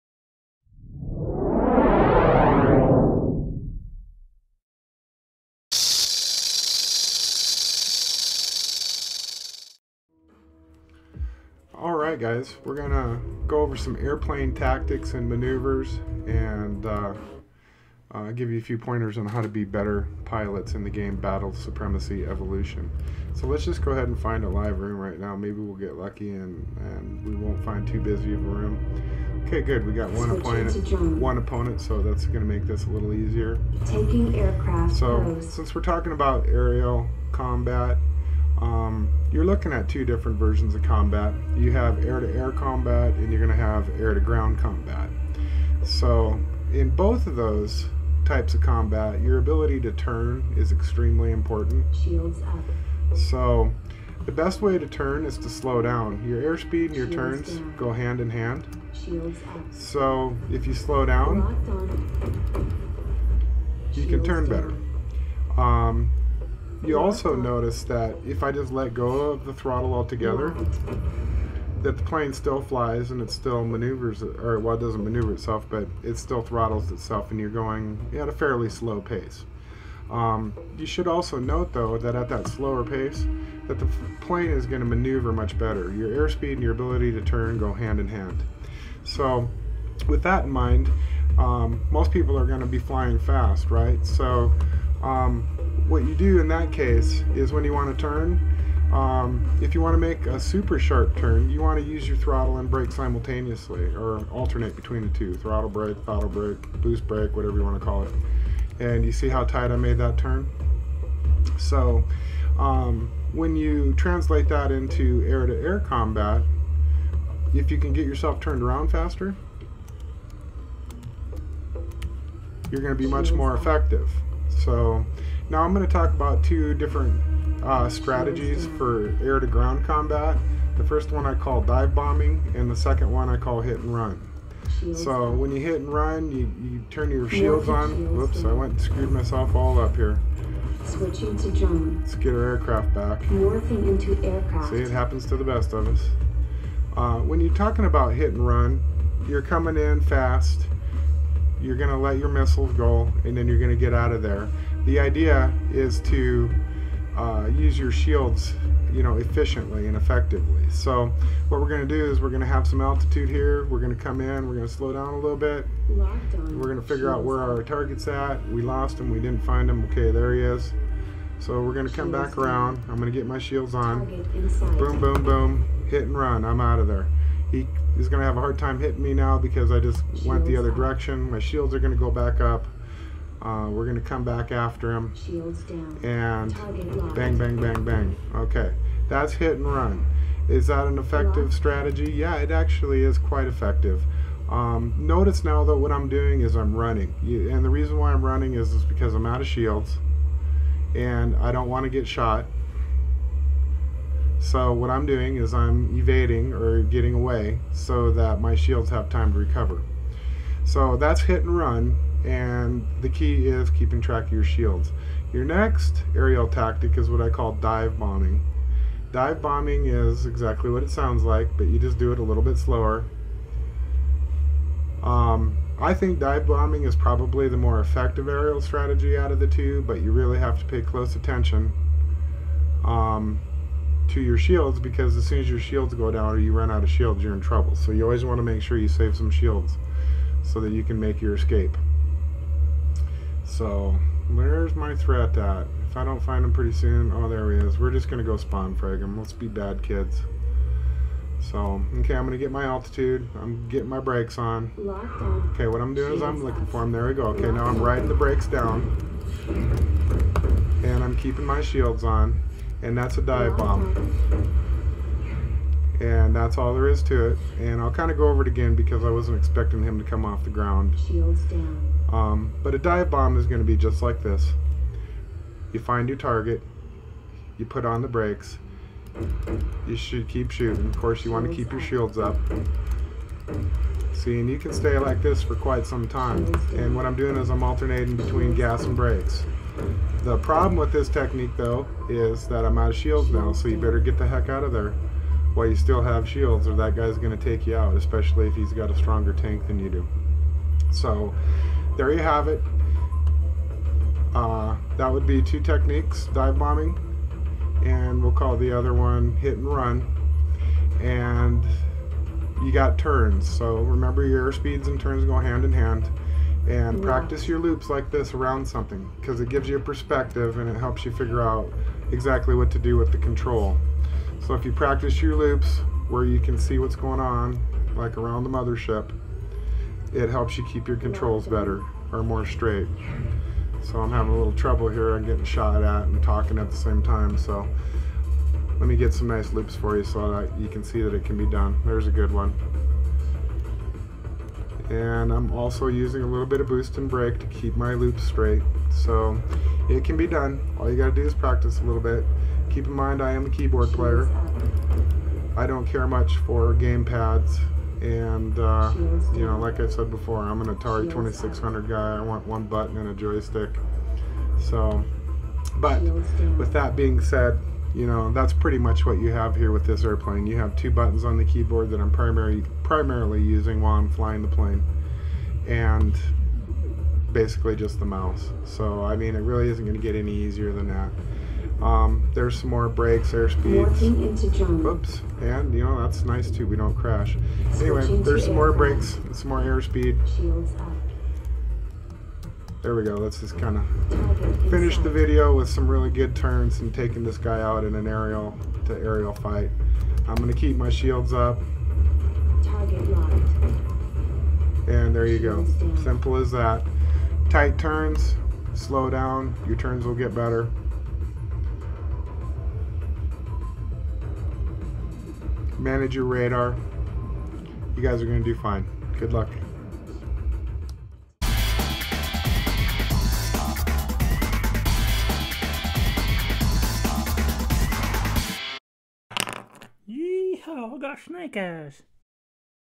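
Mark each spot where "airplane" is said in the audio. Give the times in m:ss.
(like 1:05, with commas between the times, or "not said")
0:13, 6:10.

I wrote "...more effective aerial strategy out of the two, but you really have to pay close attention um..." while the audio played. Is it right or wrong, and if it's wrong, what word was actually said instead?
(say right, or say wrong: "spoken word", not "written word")
right.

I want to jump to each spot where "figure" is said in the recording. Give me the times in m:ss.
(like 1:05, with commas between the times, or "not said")
2:46, 5:21.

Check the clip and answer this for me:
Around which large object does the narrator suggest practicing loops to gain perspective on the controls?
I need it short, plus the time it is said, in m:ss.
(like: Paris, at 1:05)
The mothership, at 5:28.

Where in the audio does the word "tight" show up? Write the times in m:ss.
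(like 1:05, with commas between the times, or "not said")
1:49, 6:47.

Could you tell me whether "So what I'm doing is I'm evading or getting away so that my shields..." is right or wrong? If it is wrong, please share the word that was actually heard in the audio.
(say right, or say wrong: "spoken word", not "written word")
right.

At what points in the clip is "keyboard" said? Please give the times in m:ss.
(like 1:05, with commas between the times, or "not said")
5:53, 6:11.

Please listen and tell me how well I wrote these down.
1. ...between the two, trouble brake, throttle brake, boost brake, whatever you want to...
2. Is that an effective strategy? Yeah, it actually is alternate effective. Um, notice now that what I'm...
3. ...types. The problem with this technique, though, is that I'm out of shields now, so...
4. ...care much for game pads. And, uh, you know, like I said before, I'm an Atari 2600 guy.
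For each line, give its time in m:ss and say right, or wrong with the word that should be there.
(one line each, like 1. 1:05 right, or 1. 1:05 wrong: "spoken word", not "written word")
1. 1:44 wrong: "throttle", not "trouble"
2. 3:10 wrong: "quite", not "alternate"
3. 4:48 wrong: "brakes", not "types"
4. 5:55 right.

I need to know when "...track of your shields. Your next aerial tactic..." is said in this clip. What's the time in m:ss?
3:34.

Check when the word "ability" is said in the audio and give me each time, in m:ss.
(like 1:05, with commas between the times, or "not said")
0:49, 1:26.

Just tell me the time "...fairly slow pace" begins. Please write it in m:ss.
1:18.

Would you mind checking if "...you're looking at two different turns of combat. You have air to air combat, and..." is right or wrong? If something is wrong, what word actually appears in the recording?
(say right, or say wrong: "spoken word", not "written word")
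wrong: "versions", not "turns".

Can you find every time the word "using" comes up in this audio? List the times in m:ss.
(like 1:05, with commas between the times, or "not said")
5:45, 6:13.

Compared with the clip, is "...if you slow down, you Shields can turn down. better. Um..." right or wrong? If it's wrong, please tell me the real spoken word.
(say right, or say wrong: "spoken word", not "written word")
right.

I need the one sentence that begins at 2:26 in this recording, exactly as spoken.
Uh, when you're talking about hit and run, you're coming in fast.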